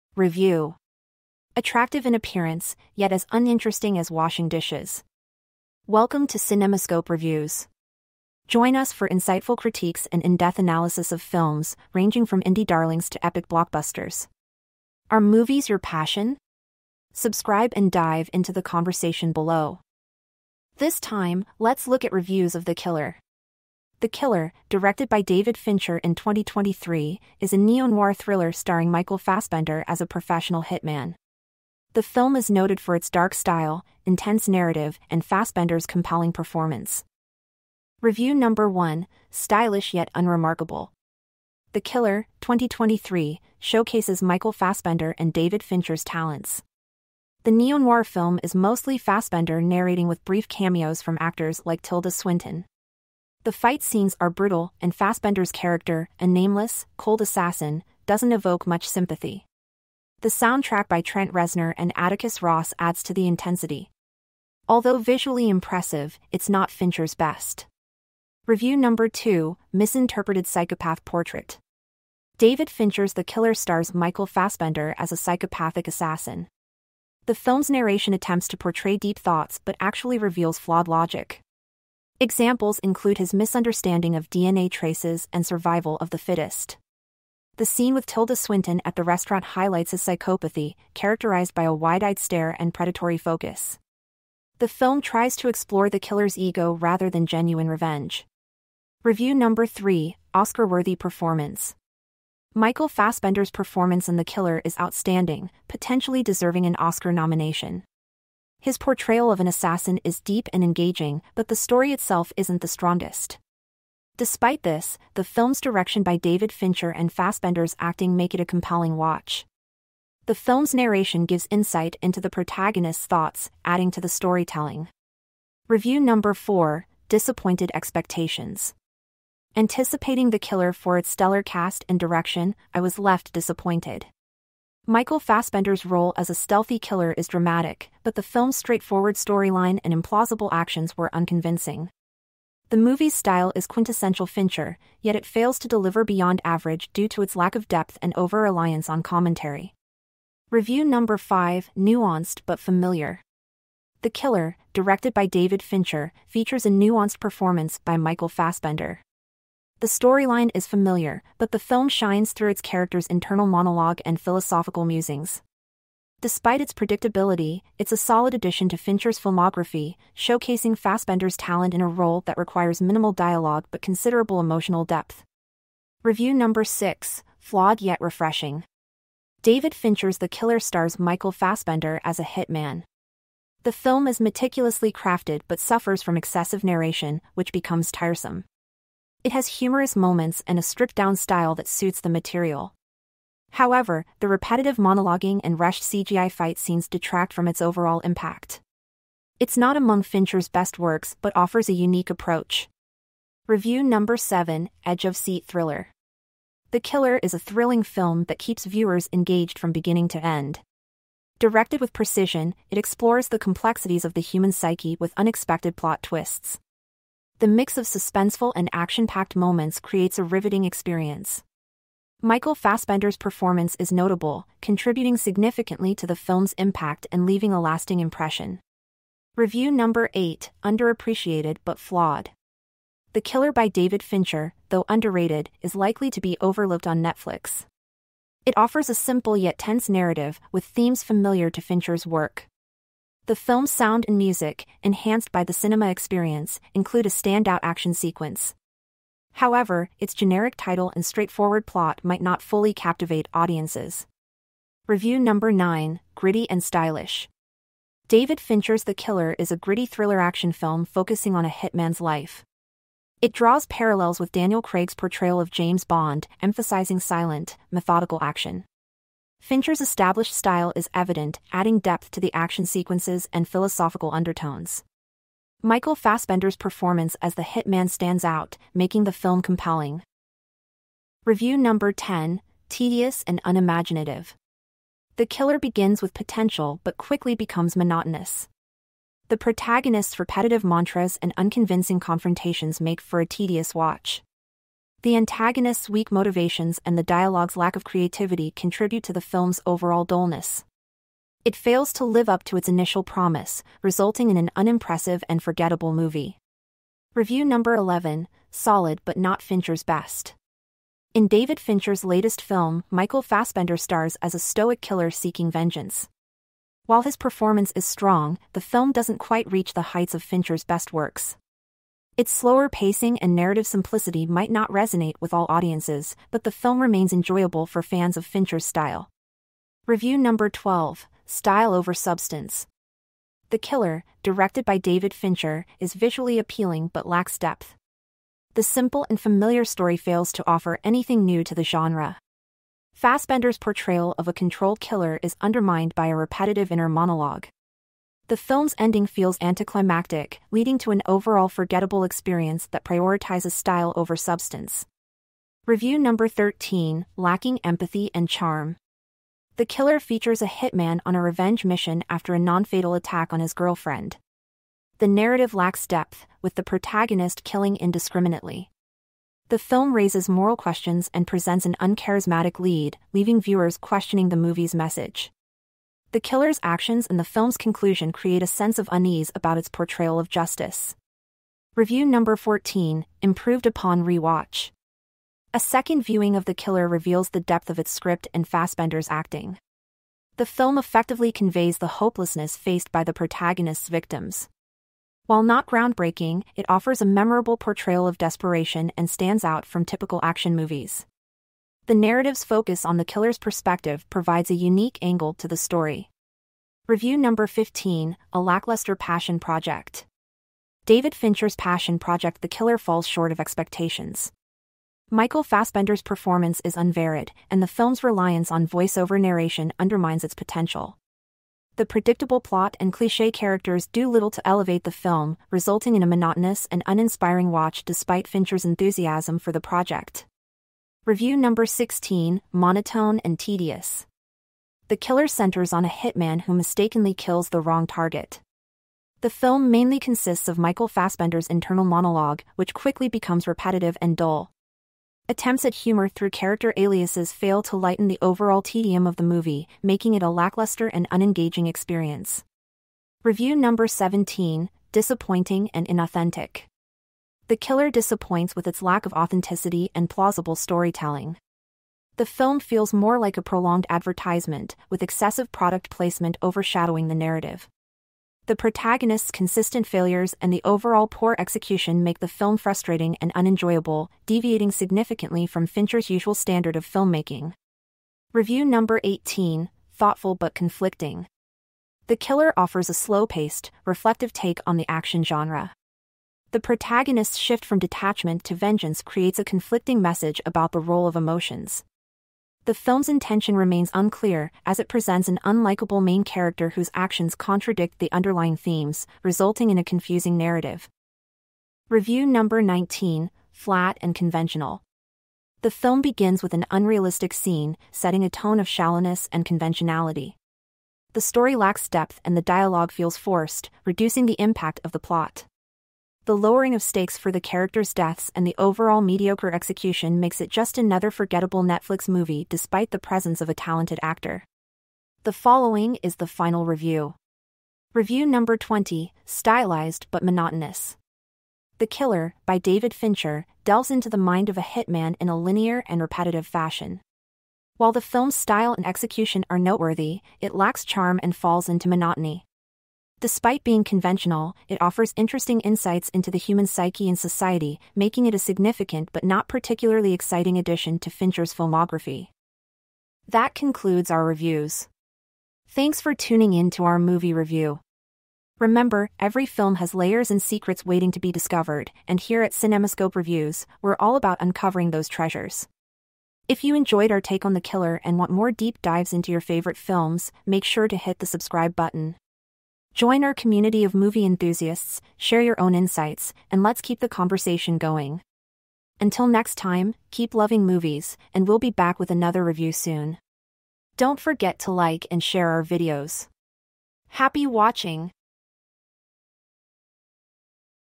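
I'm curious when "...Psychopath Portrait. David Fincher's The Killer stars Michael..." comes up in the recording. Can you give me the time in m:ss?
1:10.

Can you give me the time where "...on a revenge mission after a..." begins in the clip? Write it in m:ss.
6:01.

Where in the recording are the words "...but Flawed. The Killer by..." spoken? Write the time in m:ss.
3:51.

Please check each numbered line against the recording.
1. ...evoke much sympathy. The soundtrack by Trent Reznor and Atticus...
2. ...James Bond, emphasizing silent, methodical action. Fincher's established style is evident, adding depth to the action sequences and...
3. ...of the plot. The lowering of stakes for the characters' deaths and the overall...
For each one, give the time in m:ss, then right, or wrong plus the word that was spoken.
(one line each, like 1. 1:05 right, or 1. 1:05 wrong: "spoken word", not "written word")
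1. 0:58 right
2. 4:25 right
3. 8:34 right.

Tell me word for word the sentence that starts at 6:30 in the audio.
The film effectively conveys the hopelessness faced by the protagonist's victims.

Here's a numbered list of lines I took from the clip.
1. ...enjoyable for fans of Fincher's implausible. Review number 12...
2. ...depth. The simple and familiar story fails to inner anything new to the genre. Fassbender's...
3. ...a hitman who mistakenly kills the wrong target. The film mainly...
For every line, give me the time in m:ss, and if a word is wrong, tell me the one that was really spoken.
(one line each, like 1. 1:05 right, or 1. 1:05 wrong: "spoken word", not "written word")
1. 5:27 wrong: "style", not "implausible"
2. 5:37 wrong: "offer", not "inner"
3. 7:15 right.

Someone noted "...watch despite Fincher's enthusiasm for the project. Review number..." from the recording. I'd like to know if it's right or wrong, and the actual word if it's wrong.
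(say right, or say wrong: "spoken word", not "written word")
right.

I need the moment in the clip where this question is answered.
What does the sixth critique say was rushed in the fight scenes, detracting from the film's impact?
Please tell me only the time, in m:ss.
3:15.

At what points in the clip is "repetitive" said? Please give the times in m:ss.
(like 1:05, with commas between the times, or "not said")
3:14, 4:50, 5:46, 7:23, 8:56.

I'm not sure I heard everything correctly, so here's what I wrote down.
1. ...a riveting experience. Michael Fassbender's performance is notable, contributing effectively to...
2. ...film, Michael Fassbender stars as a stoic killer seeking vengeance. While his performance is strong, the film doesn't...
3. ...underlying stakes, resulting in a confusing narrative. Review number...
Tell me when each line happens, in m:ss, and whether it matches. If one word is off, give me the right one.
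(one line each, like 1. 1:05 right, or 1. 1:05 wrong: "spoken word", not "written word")
1. 3:40 wrong: "significantly", not "effectively"
2. 5:12 right
3. 8:18 wrong: "themes", not "stakes".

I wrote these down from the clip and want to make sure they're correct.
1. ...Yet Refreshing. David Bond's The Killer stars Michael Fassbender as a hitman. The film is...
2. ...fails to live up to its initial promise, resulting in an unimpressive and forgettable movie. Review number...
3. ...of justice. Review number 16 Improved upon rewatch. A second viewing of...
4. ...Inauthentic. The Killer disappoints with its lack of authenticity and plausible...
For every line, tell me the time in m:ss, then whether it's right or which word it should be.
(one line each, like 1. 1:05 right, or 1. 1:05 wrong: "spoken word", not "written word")
1. 2:57 wrong: "Fincher", not "Bond"
2. 5:01 right
3. 6:20 wrong: "14", not "16"
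4. 7:35 right.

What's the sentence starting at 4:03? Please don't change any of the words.
The film's sound and music, enhanced by the cinema experience, include a standout action sequence.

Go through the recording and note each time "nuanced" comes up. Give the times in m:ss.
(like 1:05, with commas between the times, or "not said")
2:31, 2:36.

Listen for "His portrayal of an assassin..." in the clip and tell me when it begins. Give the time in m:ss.
1:48.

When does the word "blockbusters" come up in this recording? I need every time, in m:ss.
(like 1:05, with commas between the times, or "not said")
0:13.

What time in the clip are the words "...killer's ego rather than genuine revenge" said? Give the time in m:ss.
1:35.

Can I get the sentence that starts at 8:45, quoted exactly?
The following is the final review.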